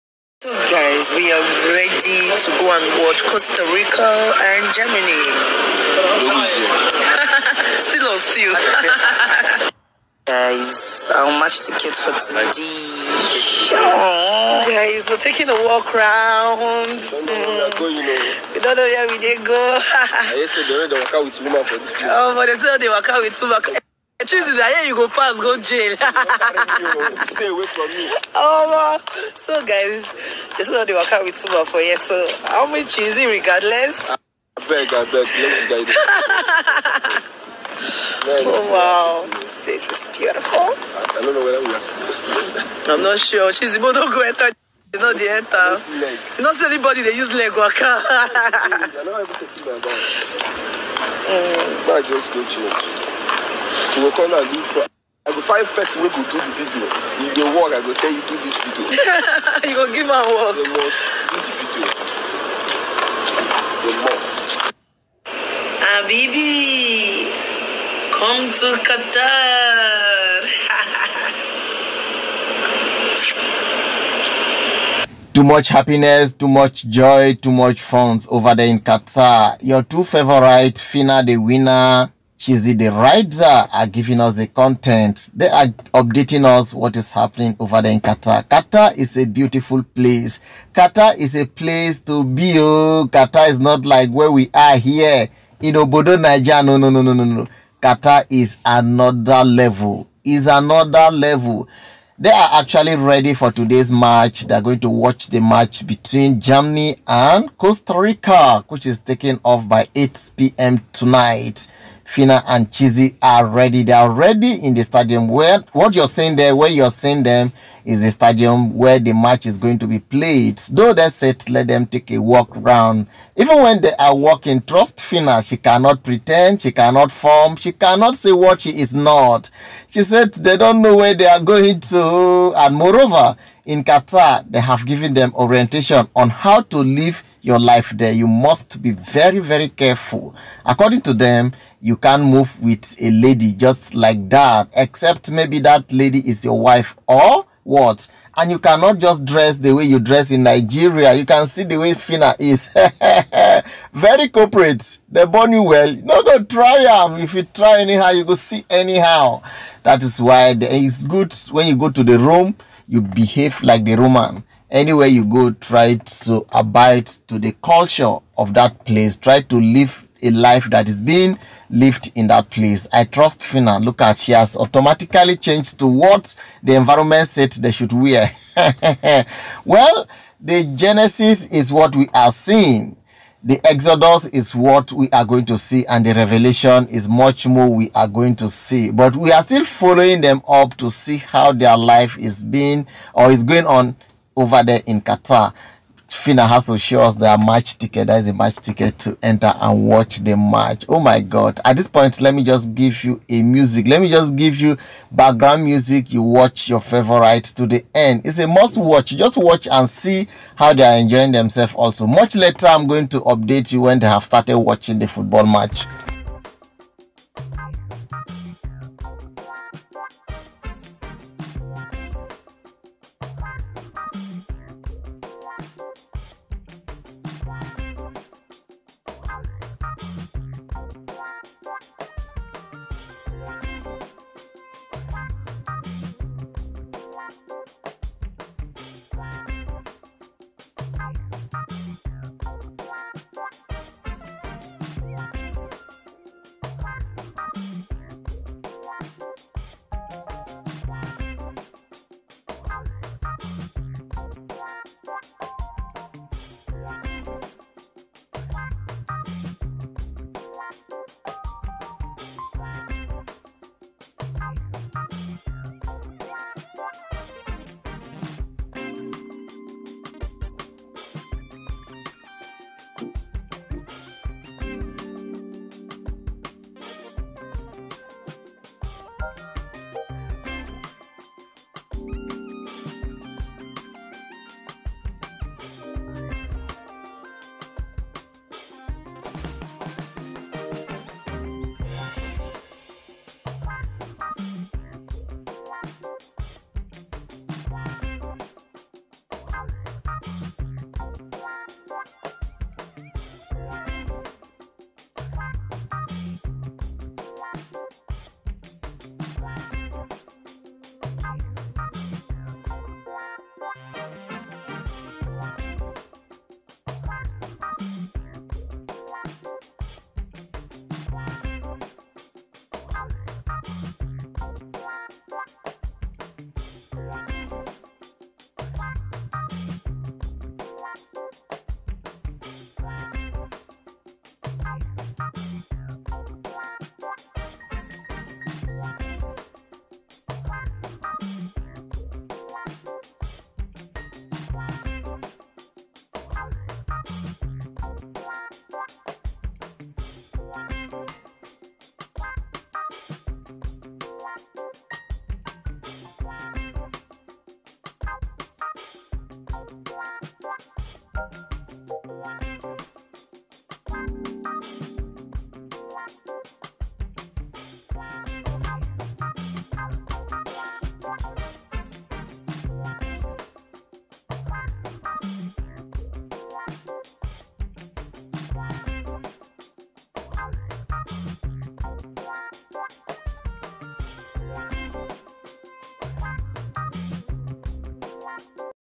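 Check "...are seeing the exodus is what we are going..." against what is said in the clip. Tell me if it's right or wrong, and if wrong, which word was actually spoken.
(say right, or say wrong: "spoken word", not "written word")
right.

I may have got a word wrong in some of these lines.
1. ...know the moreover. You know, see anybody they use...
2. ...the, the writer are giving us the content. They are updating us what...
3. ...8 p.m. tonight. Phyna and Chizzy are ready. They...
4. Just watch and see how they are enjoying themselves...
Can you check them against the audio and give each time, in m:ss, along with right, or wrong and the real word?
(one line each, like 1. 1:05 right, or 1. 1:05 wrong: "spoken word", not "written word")
1. 0:44 wrong: "enter", not "moreover"
2. 1:22 right
3. 1:49 right
4. 3:29 right.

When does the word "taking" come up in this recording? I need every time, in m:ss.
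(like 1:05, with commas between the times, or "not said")
0:15, 1:48.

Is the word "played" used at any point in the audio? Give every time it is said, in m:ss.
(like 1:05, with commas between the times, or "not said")
1:59.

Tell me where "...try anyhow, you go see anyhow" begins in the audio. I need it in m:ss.
2:37.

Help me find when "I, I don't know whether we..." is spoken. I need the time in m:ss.
0:40.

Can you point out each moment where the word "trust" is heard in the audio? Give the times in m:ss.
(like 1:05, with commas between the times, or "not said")
2:04, 2:53.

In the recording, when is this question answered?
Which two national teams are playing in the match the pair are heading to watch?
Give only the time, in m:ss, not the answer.
0:03.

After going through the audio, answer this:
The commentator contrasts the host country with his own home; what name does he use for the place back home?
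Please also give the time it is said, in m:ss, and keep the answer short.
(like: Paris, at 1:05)
Obodo, Nigeria, at 1:35.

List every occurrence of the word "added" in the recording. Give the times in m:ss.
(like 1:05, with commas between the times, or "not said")
not said.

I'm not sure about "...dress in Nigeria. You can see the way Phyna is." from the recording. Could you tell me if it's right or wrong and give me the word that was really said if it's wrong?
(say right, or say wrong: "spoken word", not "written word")
right.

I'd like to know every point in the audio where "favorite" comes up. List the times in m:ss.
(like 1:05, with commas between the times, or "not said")
1:20, 3:26.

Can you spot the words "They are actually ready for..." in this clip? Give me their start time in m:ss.
1:42.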